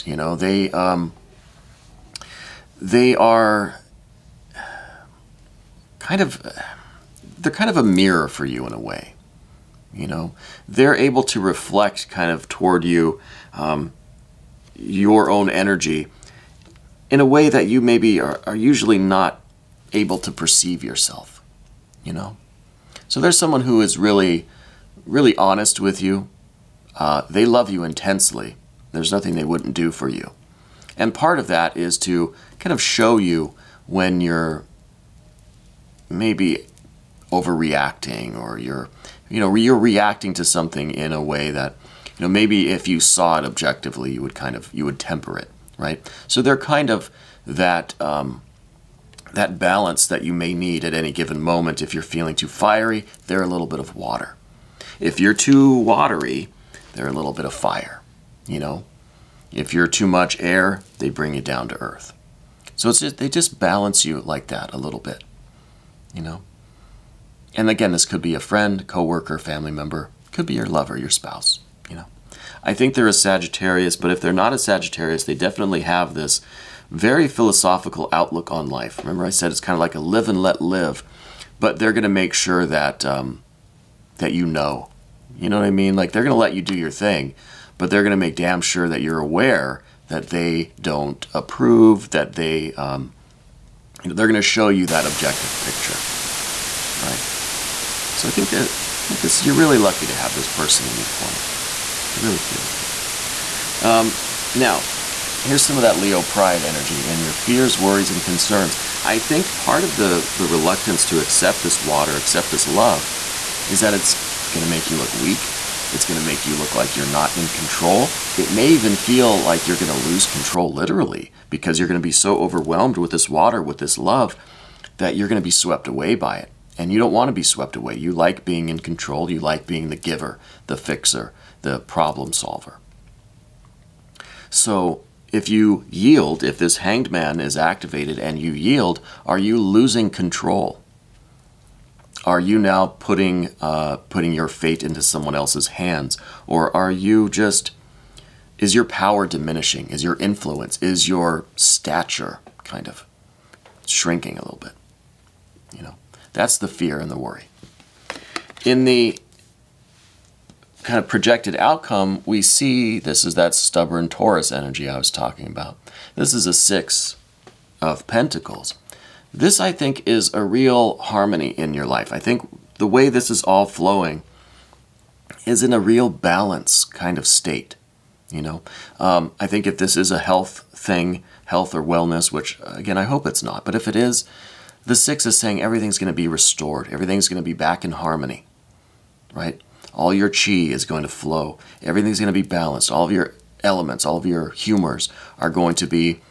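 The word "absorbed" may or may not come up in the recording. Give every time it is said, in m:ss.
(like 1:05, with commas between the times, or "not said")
not said.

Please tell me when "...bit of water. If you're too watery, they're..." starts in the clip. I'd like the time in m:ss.
0:53.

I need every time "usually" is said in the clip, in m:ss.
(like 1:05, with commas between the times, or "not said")
0:18.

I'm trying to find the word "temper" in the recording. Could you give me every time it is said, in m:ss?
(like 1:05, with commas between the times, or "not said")
0:44.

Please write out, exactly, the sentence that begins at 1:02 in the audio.
So it's just, they just balance you like that a little bit, you know?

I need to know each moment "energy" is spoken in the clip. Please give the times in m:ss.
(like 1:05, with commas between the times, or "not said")
0:15, 1:46, 2:44.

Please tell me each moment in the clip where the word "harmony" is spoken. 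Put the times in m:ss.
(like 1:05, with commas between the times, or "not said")
2:50, 3:07.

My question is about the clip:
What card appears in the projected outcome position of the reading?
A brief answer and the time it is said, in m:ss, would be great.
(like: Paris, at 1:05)
Six of Pentacles, at 2:46.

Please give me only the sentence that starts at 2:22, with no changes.
Are you now putting, uh, putting your fate into someone else's hands?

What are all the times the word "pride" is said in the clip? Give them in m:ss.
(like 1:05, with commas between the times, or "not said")
1:46.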